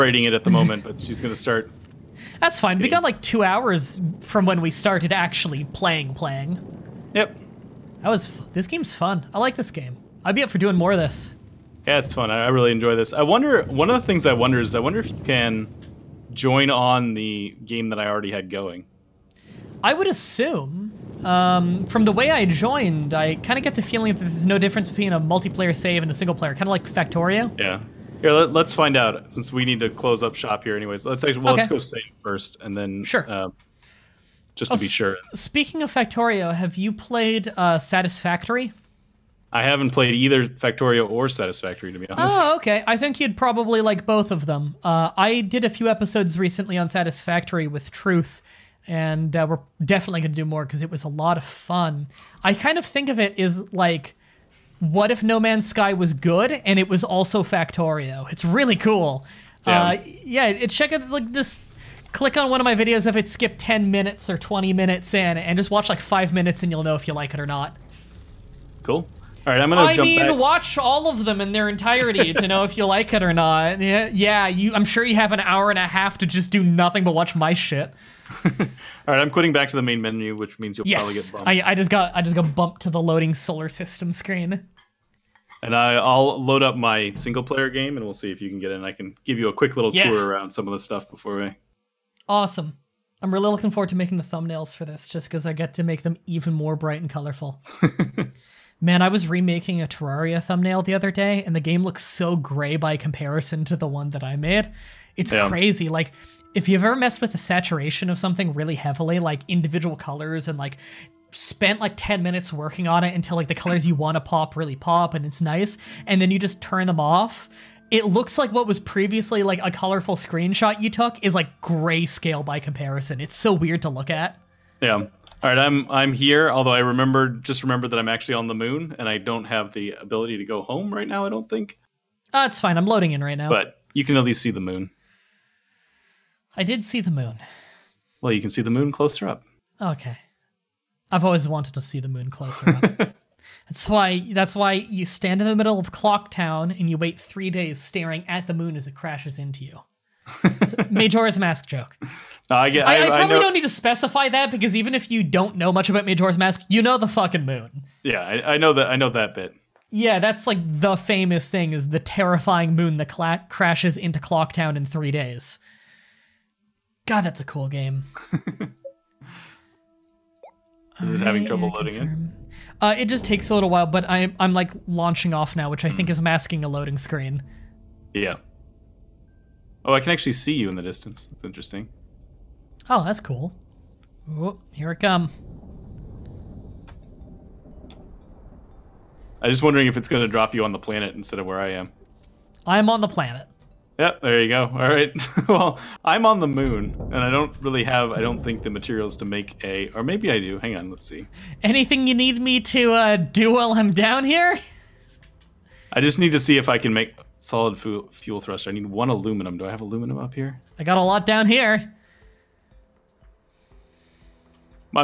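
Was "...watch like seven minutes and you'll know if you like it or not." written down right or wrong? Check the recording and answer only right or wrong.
wrong.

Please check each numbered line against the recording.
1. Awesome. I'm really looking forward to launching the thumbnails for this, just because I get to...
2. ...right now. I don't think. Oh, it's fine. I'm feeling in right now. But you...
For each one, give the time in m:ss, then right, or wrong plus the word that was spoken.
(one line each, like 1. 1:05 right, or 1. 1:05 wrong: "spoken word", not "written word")
1. 1:32 wrong: "making", not "launching"
2. 2:10 wrong: "loading", not "feeling".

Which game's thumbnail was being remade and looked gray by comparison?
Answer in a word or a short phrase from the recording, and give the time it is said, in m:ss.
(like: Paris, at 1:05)
Terraria, at 1:39.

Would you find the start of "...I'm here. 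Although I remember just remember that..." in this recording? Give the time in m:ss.
2:05.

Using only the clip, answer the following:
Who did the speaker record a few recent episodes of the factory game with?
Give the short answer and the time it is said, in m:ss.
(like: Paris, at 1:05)
Truth, at 0:47.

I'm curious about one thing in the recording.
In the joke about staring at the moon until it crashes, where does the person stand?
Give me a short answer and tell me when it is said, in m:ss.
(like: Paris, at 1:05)
Clock Town, at 2:25.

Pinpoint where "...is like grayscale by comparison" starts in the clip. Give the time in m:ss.
2:01.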